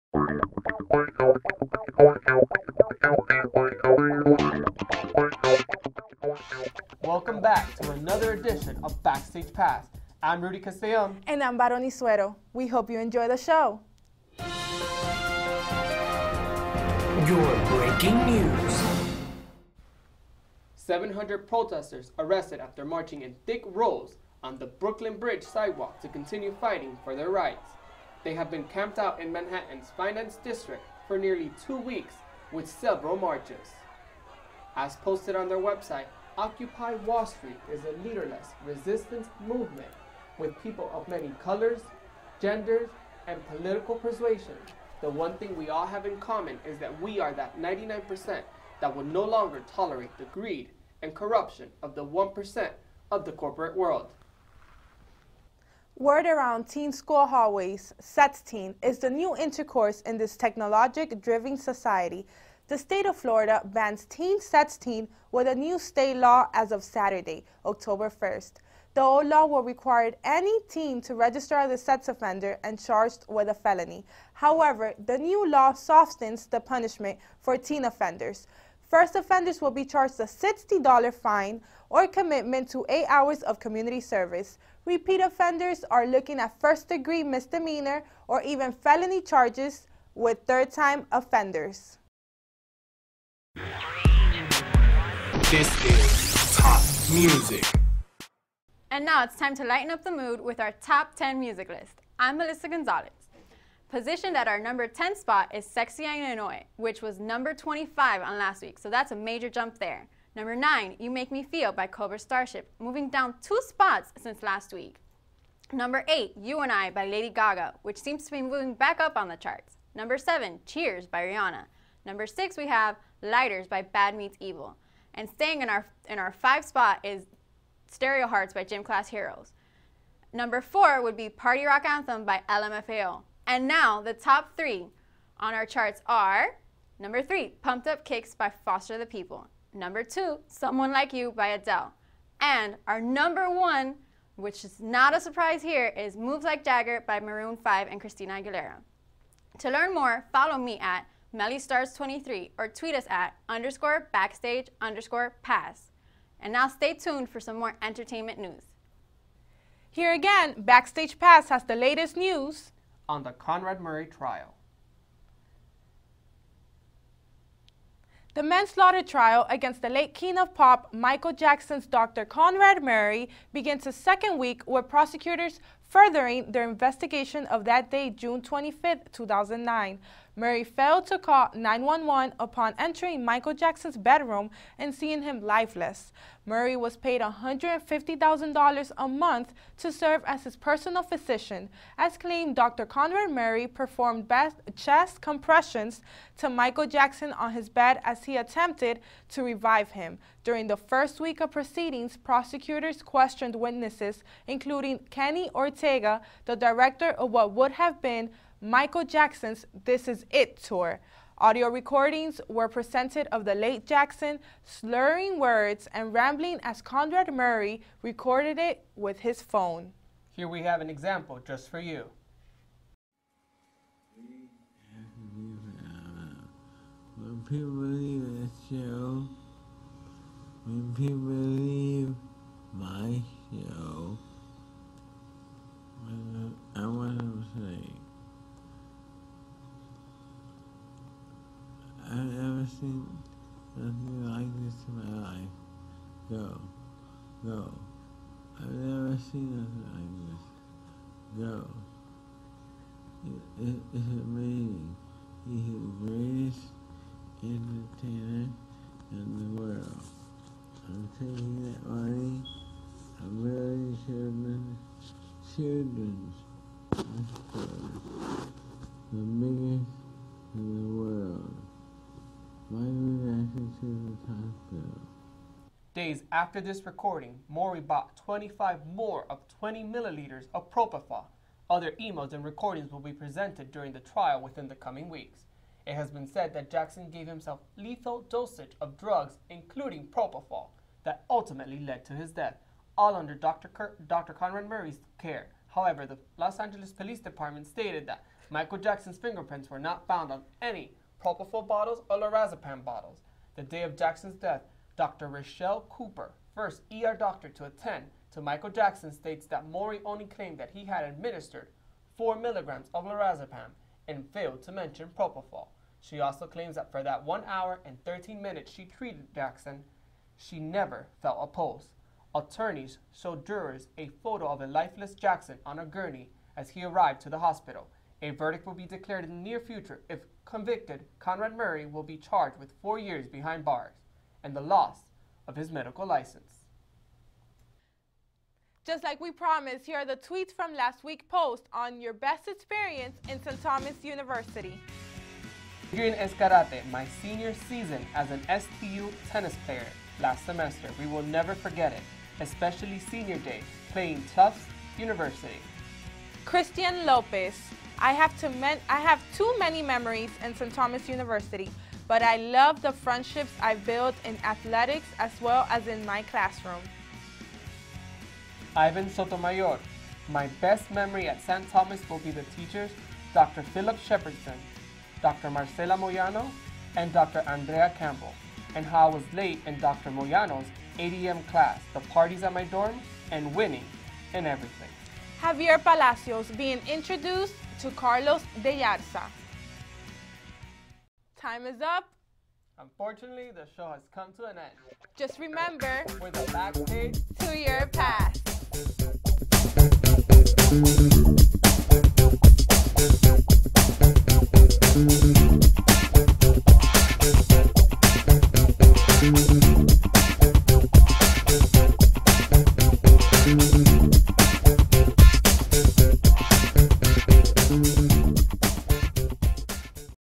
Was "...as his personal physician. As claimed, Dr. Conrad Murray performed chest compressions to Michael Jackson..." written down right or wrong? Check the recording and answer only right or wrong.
right.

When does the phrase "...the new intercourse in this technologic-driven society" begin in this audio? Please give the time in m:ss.
0:58.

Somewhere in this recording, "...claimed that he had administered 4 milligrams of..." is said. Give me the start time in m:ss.
5:10.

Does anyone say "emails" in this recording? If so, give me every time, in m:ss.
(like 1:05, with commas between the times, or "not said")
4:41.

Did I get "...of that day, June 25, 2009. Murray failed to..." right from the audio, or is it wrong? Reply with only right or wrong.
right.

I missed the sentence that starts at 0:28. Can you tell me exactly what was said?
They have been camped out in Manhattan's Finance District for nearly two weeks with several marches.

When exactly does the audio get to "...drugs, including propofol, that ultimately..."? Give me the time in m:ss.
4:48.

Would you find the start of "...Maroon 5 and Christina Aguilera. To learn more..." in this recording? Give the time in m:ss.
2:27.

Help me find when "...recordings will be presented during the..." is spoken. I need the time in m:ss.
4:42.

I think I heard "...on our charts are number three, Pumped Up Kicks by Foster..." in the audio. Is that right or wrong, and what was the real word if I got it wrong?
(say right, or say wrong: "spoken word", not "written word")
right.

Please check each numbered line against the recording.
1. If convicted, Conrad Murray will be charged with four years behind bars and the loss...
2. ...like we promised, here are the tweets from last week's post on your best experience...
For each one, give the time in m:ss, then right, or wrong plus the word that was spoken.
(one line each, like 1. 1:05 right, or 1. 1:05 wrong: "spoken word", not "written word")
1. 5:30 right
2. 5:39 right.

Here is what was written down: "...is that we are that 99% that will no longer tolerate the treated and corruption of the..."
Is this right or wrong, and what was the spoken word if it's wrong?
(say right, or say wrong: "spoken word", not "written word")
wrong: "greed", not "treated".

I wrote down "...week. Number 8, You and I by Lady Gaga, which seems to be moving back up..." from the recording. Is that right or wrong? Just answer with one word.
right.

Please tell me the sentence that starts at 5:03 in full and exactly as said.
The day of Jackson's death, Dr.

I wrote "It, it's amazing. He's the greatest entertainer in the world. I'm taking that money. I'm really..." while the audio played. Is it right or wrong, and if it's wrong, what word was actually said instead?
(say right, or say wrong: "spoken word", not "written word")
right.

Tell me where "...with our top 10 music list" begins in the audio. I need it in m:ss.
1:40.